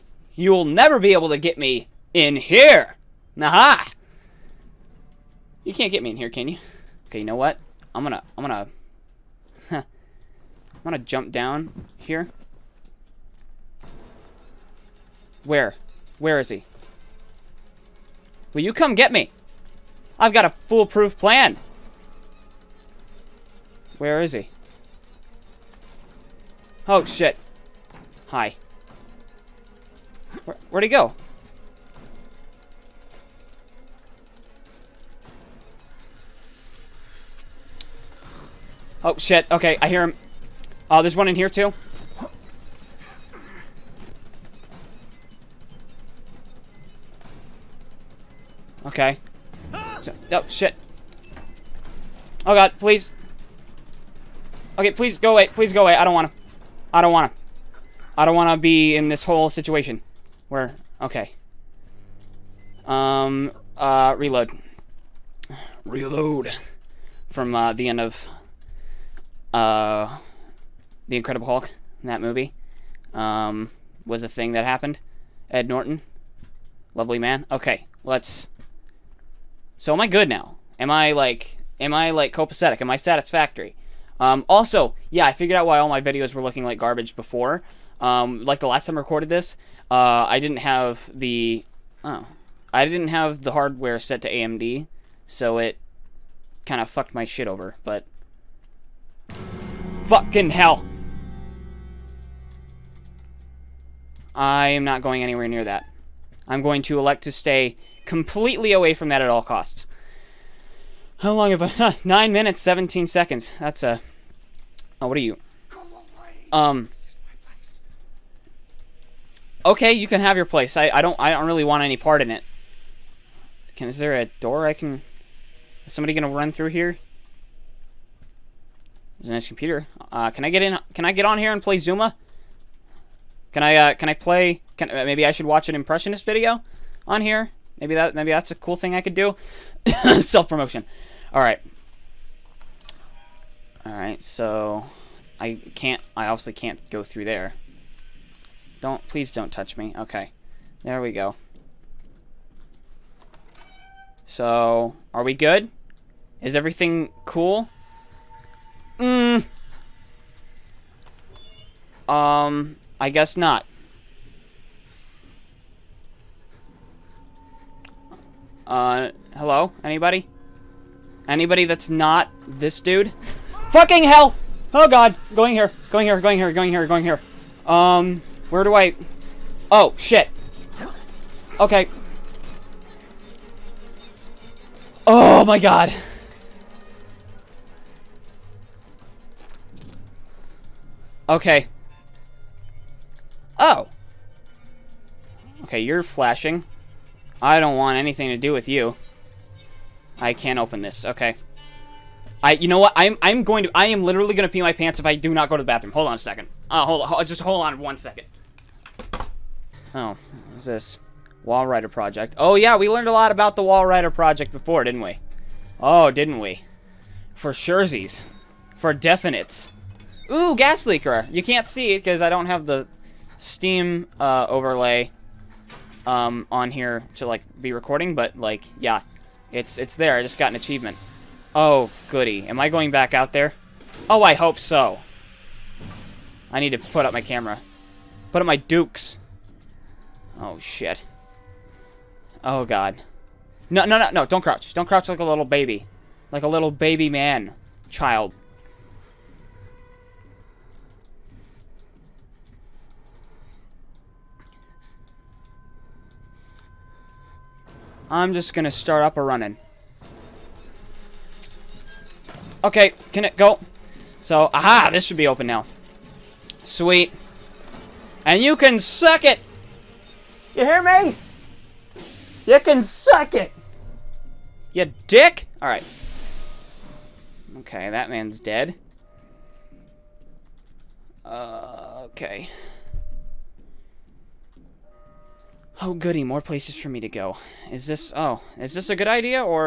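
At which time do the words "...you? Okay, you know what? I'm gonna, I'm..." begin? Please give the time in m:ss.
0:06.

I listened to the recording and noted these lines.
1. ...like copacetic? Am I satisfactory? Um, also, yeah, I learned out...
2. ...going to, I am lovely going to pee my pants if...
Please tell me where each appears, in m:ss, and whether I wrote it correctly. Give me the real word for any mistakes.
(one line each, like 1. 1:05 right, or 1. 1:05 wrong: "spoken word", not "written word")
1. 1:22 wrong: "figured", not "learned"
2. 3:23 wrong: "literally", not "lovely".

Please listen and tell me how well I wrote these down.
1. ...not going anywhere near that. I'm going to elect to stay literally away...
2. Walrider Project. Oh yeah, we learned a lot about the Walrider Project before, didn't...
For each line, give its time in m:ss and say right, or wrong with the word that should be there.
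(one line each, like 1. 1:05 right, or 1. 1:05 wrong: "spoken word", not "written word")
1. 1:44 wrong: "completely", not "literally"
2. 3:31 right.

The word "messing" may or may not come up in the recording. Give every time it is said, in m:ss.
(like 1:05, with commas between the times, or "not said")
not said.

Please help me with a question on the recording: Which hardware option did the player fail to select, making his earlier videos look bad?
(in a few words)
AMD.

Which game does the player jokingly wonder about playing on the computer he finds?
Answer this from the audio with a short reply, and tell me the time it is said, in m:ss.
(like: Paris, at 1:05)
Zuma, at 2:11.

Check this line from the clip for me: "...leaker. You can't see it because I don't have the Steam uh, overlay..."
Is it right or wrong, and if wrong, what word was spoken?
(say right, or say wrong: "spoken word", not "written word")
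right.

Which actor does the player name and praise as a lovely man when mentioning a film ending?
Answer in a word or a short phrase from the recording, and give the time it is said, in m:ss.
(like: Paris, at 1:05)
Ed Norton, at 1:15.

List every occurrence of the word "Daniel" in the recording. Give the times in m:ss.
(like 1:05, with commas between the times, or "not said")
not said.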